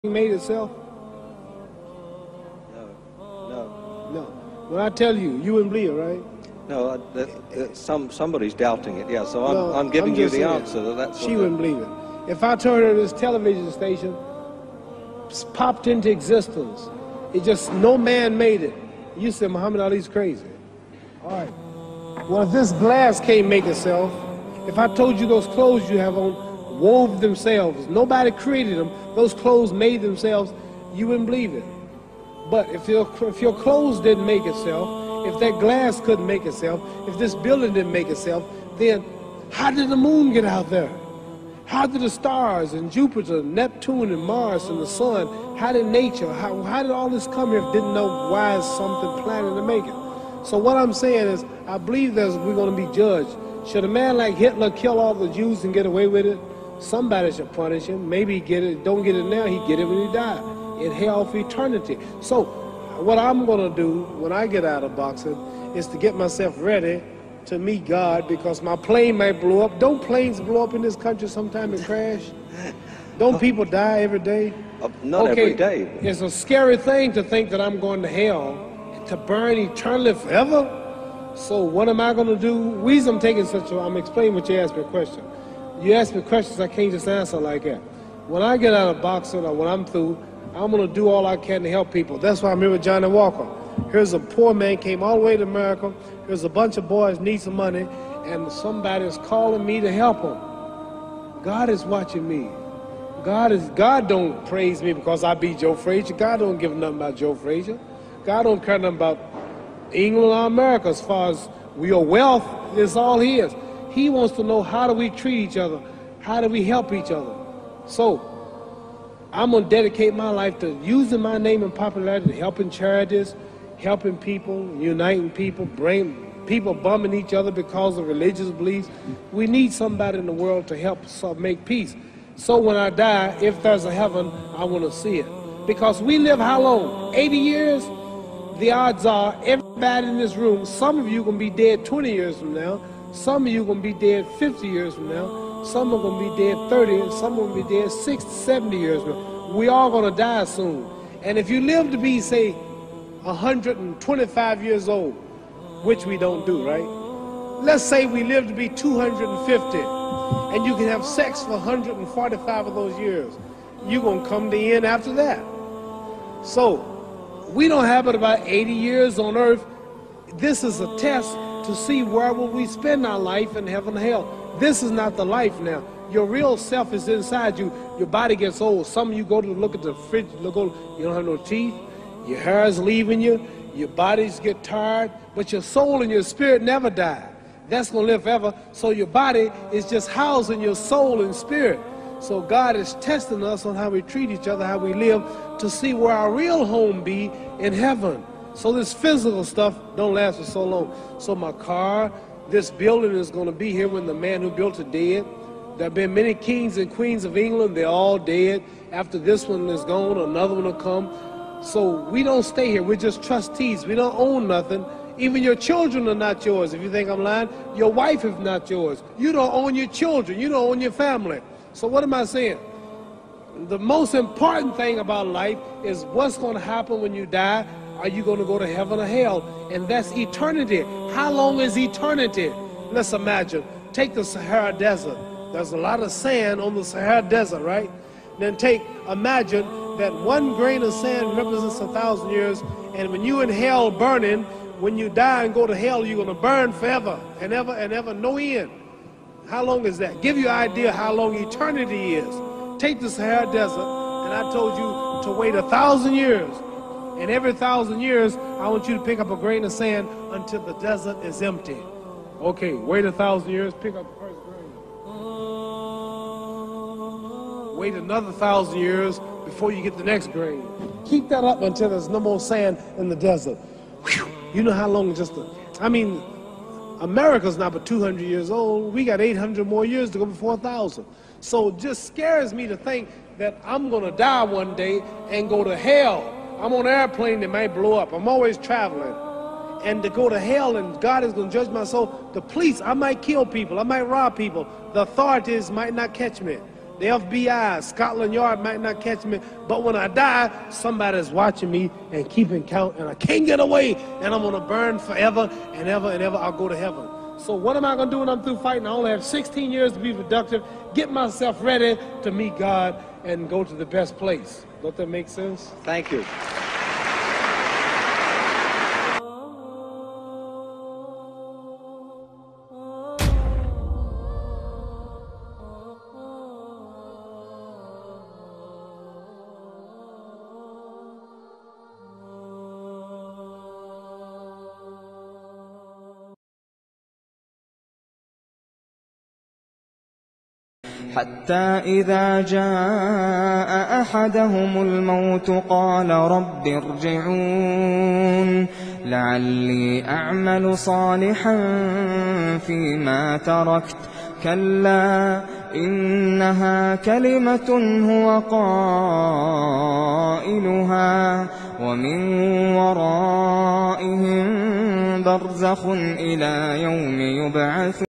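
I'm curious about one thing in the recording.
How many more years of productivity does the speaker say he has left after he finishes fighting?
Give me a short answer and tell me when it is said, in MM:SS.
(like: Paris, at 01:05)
16, at 05:09.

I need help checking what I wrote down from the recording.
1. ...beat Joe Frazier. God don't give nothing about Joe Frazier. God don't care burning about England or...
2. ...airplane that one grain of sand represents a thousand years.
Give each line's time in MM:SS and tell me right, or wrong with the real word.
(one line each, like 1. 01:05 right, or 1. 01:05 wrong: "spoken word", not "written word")
1. 01:45 wrong: "nothing", not "burning"
2. 03:59 wrong: "imagine", not "airplane".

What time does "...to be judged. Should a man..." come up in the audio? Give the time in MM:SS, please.
00:52.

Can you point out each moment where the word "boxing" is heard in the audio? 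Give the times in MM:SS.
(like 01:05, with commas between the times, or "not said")
01:04, 01:29.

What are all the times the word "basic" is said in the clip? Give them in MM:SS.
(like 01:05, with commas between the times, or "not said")
not said.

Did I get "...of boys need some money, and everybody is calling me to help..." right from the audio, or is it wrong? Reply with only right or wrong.
wrong.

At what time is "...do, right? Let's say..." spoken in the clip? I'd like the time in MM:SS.
02:36.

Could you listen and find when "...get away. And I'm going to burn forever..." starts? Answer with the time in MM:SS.
05:03.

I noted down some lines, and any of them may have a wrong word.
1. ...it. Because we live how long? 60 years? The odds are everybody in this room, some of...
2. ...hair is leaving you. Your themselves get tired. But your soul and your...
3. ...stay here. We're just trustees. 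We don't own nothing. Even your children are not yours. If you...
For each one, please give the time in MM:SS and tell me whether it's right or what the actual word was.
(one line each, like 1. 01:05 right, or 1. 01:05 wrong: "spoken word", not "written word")
1. 02:15 wrong: "80", not "60"
2. 03:02 wrong: "bodies", not "themselves"
3. 03:32 right.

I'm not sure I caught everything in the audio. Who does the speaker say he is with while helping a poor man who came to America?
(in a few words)
Johnny Walker.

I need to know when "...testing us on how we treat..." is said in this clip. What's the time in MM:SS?
03:12.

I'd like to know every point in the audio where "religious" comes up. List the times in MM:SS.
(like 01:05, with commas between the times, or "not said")
02:08.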